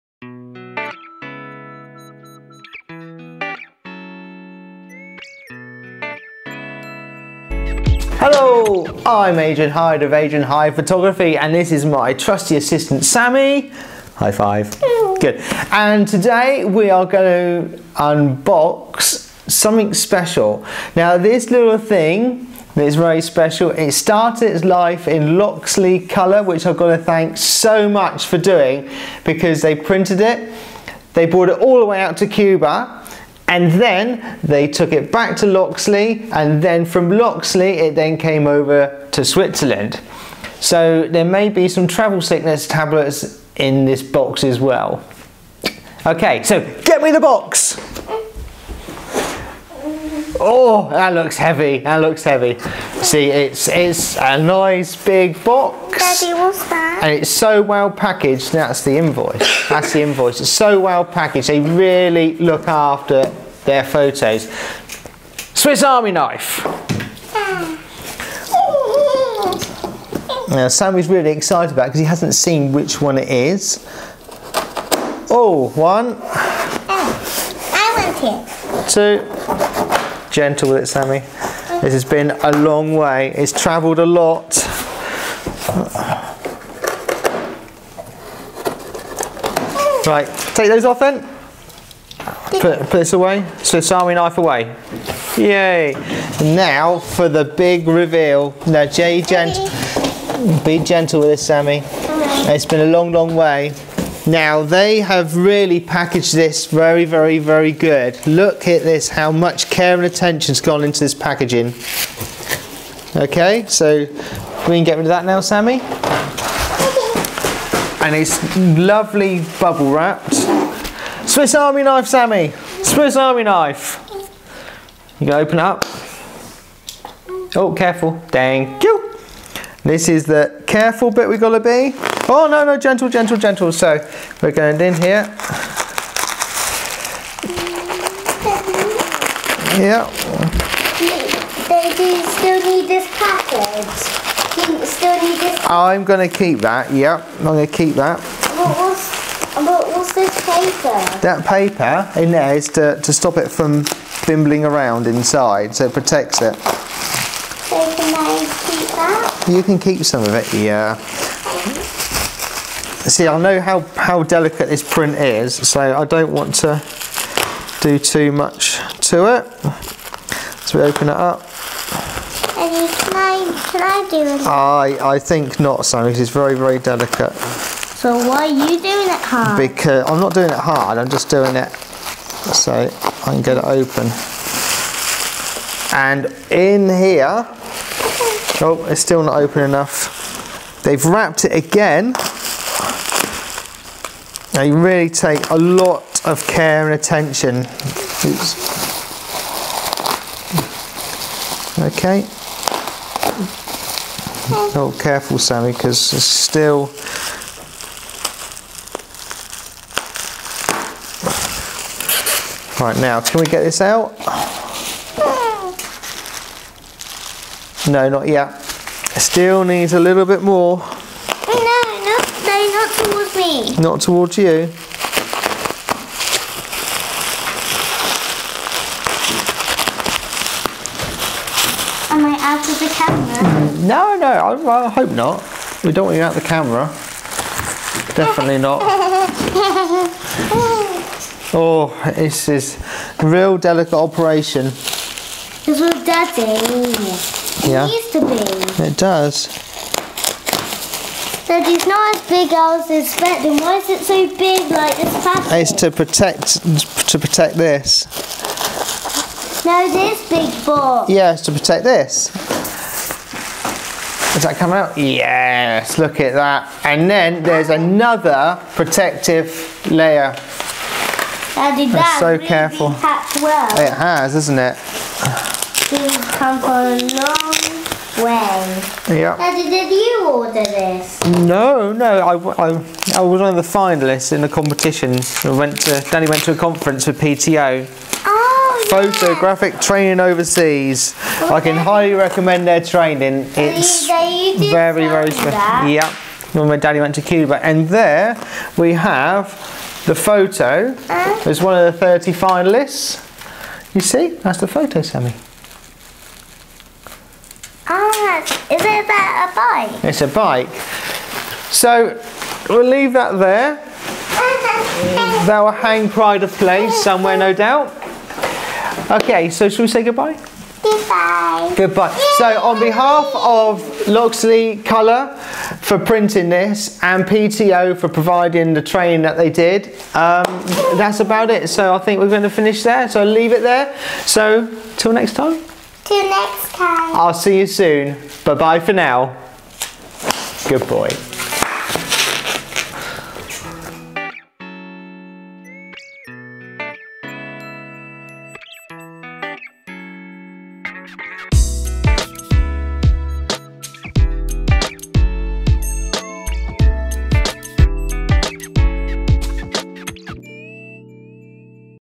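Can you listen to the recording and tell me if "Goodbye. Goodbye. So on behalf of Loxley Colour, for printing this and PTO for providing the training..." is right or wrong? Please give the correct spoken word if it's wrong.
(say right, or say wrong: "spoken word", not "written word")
right.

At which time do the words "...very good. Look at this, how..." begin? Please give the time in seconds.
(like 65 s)
107 s.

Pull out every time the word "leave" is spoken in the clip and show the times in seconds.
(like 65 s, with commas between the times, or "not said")
312 s, 333 s.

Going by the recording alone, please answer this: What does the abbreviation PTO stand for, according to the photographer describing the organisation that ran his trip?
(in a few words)
Photographic Training Overseas.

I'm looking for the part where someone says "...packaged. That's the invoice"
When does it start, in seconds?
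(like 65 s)
57 s.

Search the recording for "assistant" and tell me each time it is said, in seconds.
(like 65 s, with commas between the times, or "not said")
12 s.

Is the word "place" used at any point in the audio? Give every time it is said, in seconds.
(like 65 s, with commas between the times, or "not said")
316 s.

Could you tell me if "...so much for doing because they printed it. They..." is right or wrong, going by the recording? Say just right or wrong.
right.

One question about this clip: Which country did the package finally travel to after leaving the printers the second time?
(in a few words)
Switzerland.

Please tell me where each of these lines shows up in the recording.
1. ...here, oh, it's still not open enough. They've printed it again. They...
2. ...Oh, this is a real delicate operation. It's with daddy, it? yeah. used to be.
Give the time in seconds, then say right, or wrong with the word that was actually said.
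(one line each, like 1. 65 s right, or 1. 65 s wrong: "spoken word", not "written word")
1. 186 s wrong: "wrapped", not "printed"
2. 241 s right.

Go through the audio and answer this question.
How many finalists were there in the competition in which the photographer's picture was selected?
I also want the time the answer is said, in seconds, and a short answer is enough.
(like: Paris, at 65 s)
30, at 301 s.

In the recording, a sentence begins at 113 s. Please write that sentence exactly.
Okay, so we can get rid of that now, Sammy.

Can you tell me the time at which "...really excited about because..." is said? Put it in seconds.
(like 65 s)
71 s.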